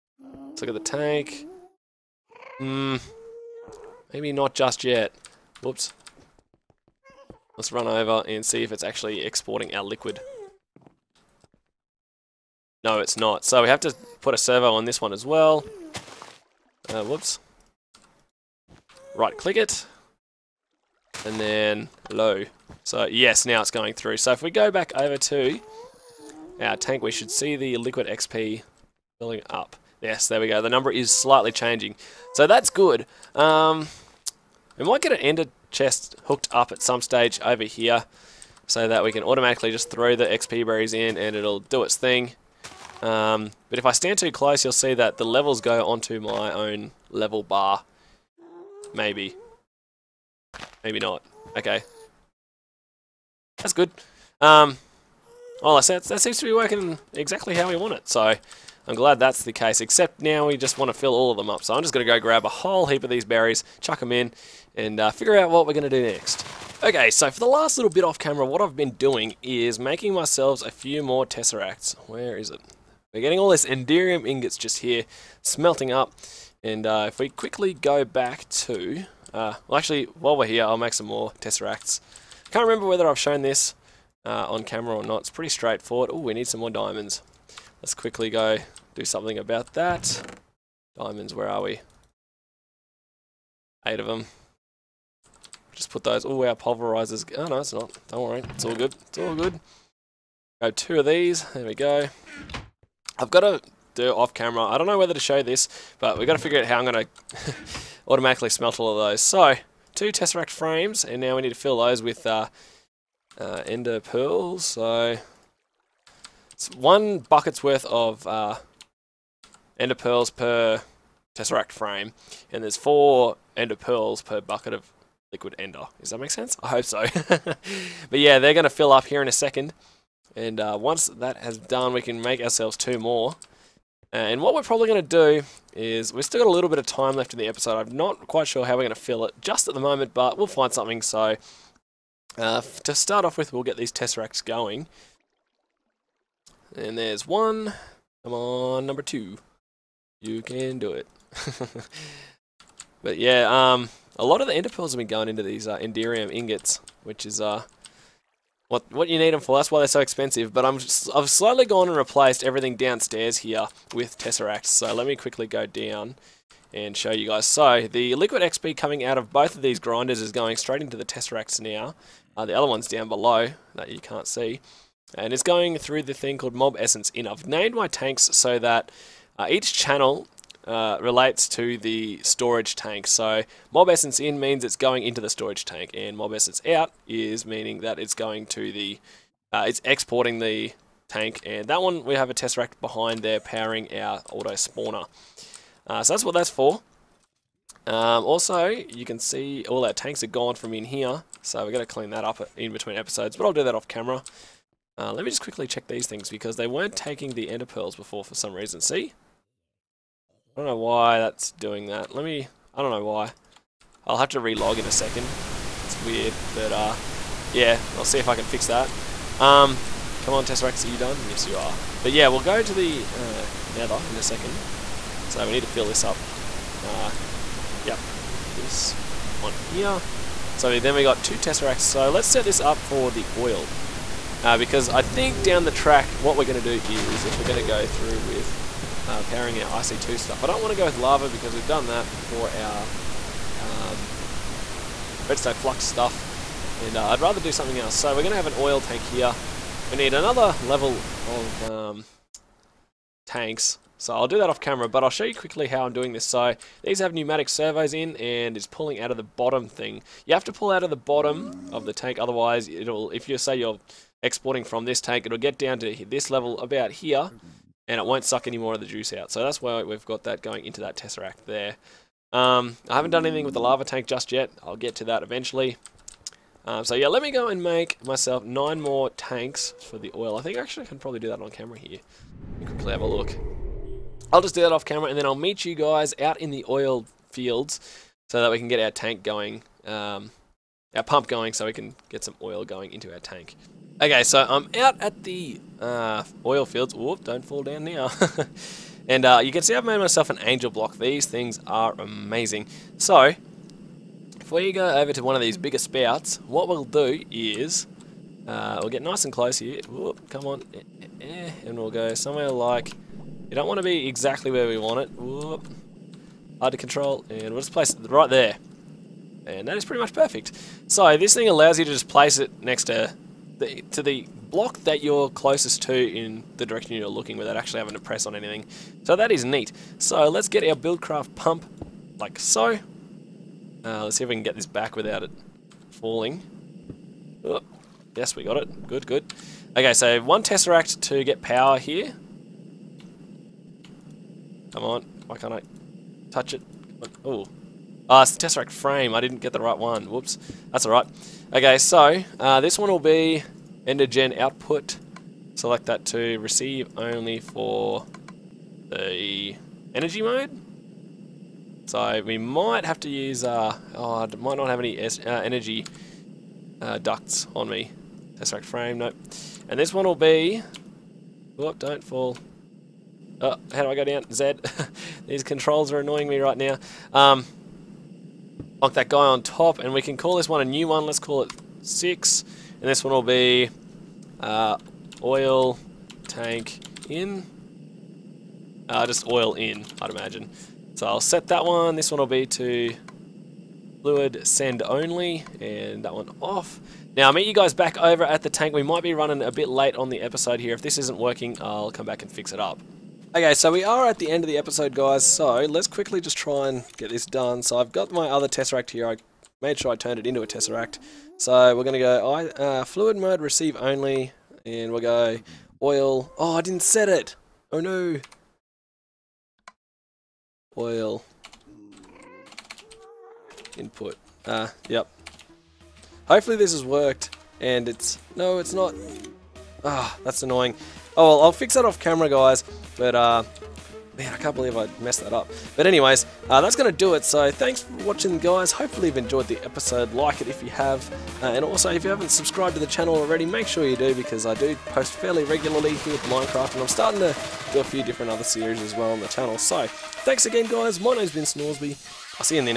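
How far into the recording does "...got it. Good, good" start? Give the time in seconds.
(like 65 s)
338 s.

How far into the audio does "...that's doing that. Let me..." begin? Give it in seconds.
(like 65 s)
211 s.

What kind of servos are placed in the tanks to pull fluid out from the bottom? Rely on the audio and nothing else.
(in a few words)
Pneumatic servos.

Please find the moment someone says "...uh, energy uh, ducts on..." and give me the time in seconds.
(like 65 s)
365 s.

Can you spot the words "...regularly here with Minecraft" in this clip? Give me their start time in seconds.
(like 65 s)
445 s.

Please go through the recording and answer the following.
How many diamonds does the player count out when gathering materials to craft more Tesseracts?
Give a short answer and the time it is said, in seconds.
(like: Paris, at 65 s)
8, at 93 s.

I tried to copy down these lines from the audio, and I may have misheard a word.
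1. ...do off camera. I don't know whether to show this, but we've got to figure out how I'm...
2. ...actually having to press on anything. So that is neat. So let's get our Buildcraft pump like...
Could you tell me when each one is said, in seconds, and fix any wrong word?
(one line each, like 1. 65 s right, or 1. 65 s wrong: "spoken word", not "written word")
1. 103 s right
2. 327 s right.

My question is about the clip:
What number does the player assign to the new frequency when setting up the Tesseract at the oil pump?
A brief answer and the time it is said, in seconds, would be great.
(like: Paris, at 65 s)
6, at 381 s.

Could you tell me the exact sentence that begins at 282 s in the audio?
You can quickly have a look.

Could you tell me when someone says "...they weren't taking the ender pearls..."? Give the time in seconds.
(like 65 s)
206 s.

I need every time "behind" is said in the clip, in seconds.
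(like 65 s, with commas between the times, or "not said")
192 s.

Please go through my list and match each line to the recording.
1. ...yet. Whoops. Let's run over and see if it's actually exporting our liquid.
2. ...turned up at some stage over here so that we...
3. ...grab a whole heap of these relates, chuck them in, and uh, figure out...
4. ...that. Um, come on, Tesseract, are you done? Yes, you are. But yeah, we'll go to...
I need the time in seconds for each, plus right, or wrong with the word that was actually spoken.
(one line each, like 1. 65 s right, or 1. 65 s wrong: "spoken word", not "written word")
1. 4 s right
2. 36 s wrong: "hooked", not "turned"
3. 62 s wrong: "berries", not "relates"
4. 218 s right.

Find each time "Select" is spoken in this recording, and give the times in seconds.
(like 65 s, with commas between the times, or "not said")
355 s.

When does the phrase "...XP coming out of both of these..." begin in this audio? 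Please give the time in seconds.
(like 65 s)
168 s.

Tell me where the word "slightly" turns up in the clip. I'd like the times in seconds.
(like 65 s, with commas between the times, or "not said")
31 s, 161 s.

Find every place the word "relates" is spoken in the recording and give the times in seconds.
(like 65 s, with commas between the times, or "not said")
181 s.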